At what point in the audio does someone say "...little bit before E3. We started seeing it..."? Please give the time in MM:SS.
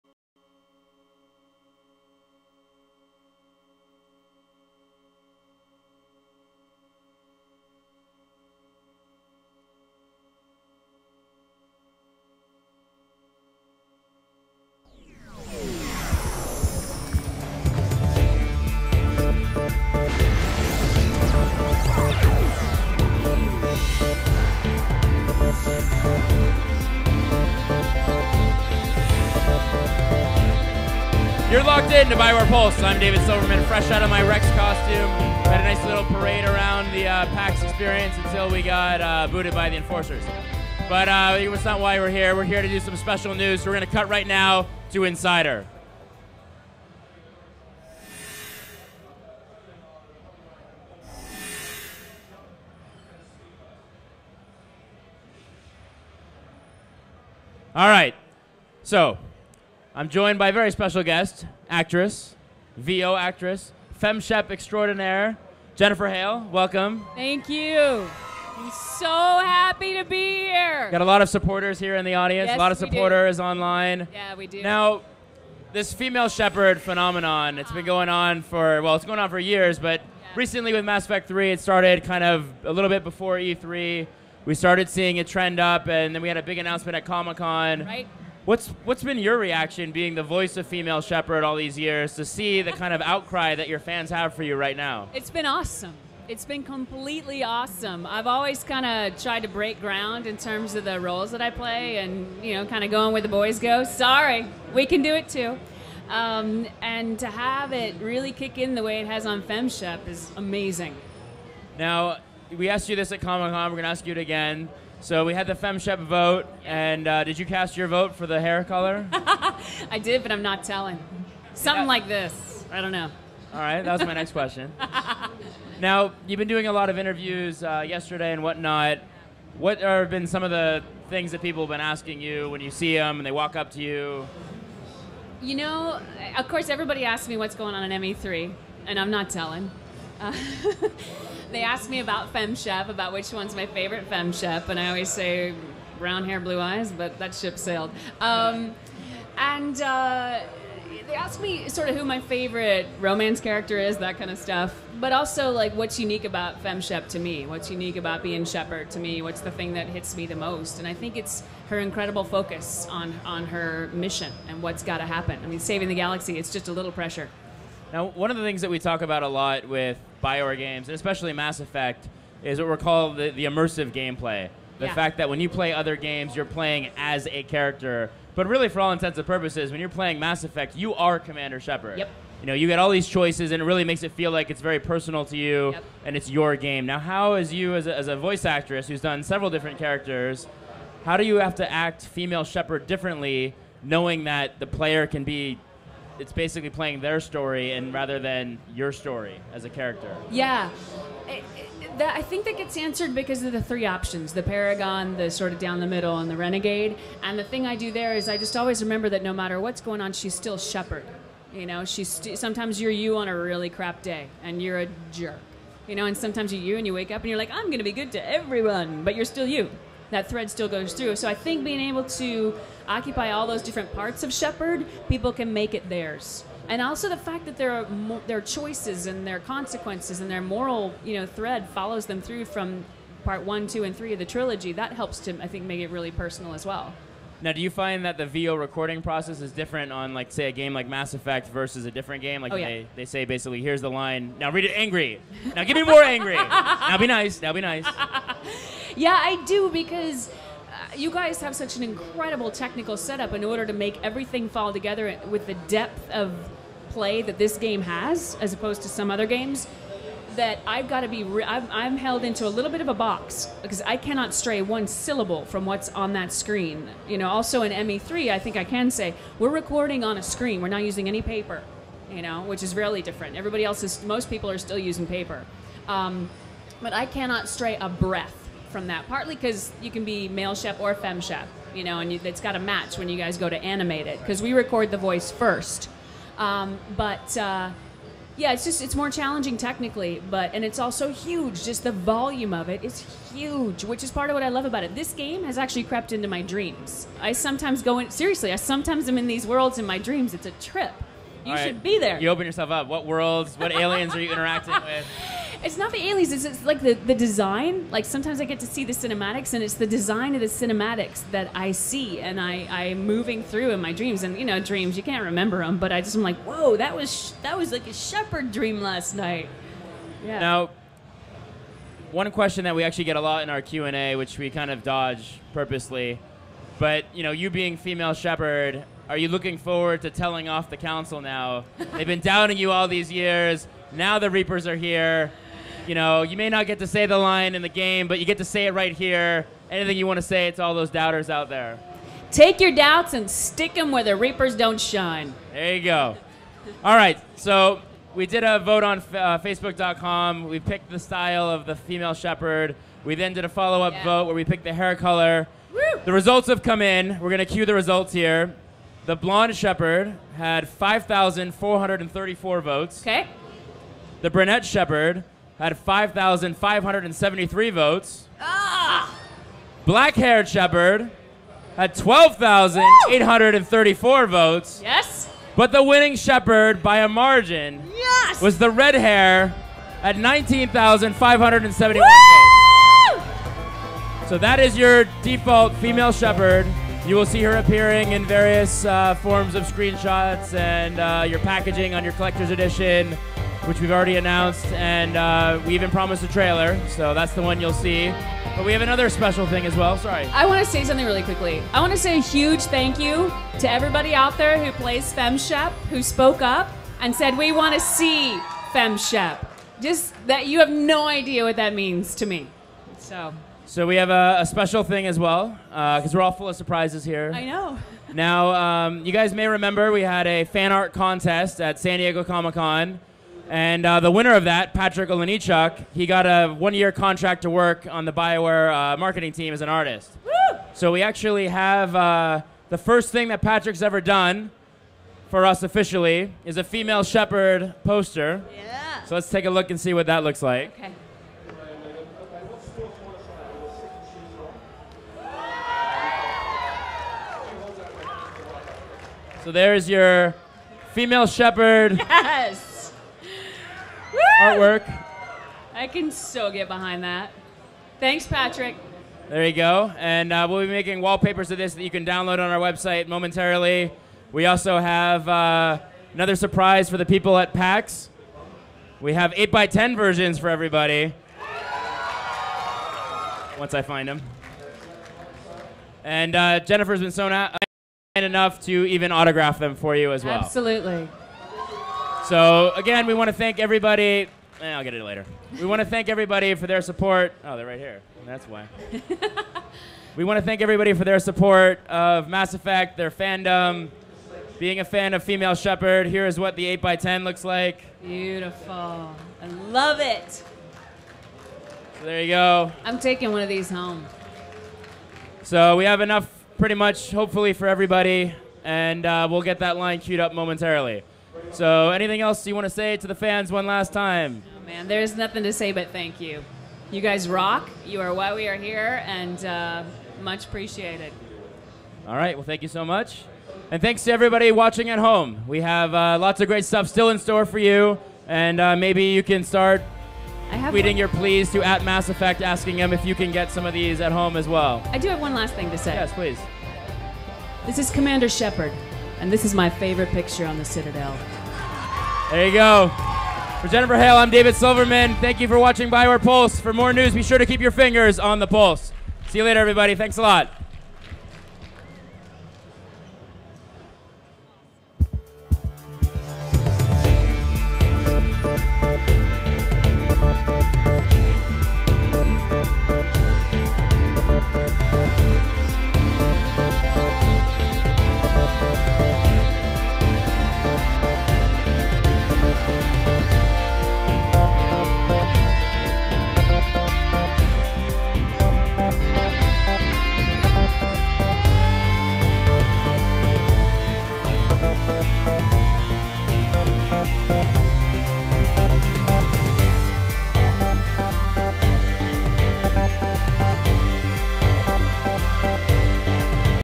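01:22.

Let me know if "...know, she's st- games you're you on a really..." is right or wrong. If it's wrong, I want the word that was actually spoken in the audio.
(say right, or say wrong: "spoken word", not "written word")
wrong: "sometimes", not "games".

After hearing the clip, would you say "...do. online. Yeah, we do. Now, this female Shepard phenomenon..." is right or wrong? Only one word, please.
right.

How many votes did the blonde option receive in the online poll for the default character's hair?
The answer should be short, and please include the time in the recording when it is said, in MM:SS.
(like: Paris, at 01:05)
5,434, at 06:00.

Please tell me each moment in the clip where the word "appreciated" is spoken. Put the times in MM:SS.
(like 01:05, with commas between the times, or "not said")
08:40.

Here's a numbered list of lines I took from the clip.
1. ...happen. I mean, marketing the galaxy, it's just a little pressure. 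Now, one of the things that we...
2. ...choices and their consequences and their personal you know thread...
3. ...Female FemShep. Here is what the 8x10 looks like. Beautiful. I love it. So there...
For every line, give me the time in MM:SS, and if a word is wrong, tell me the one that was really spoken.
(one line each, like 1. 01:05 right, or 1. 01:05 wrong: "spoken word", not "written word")
1. 02:45 wrong: "saving", not "marketing"
2. 03:48 wrong: "moral", not "personal"
3. 08:15 wrong: "Shepard", not "FemShep".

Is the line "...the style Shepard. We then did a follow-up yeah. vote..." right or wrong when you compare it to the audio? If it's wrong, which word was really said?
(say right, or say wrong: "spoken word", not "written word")
wrong: "female", not "style".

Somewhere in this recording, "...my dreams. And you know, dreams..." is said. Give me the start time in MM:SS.
05:13.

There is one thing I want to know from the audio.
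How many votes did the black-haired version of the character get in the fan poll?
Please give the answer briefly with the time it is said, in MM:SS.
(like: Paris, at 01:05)
12,834, at 06:11.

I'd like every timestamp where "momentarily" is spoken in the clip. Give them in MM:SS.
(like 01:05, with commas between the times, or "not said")
07:43, 08:30.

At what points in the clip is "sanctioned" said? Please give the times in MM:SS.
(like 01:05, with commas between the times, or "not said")
not said.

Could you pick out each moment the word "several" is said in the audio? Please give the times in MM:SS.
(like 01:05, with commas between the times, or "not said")
03:09.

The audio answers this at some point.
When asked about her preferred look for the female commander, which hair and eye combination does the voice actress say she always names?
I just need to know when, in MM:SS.
02:25.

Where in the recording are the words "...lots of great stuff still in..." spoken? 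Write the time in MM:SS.
08:46.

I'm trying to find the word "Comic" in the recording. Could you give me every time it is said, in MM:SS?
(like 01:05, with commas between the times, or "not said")
01:27, 01:53, 07:02.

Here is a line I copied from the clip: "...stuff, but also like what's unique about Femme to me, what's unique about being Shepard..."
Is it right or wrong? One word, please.
right.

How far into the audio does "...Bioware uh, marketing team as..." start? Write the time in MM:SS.
07:08.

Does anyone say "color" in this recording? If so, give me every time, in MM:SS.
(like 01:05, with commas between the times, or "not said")
01:58, 05:54.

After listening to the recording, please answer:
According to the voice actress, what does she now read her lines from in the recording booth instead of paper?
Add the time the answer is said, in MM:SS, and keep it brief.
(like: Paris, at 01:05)
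a screen, at 04:30.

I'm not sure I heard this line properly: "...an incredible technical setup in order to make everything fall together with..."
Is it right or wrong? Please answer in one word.
right.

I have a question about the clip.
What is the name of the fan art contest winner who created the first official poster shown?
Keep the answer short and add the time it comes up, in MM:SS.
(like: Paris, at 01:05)
Patrick Olenichuk, at 07:04.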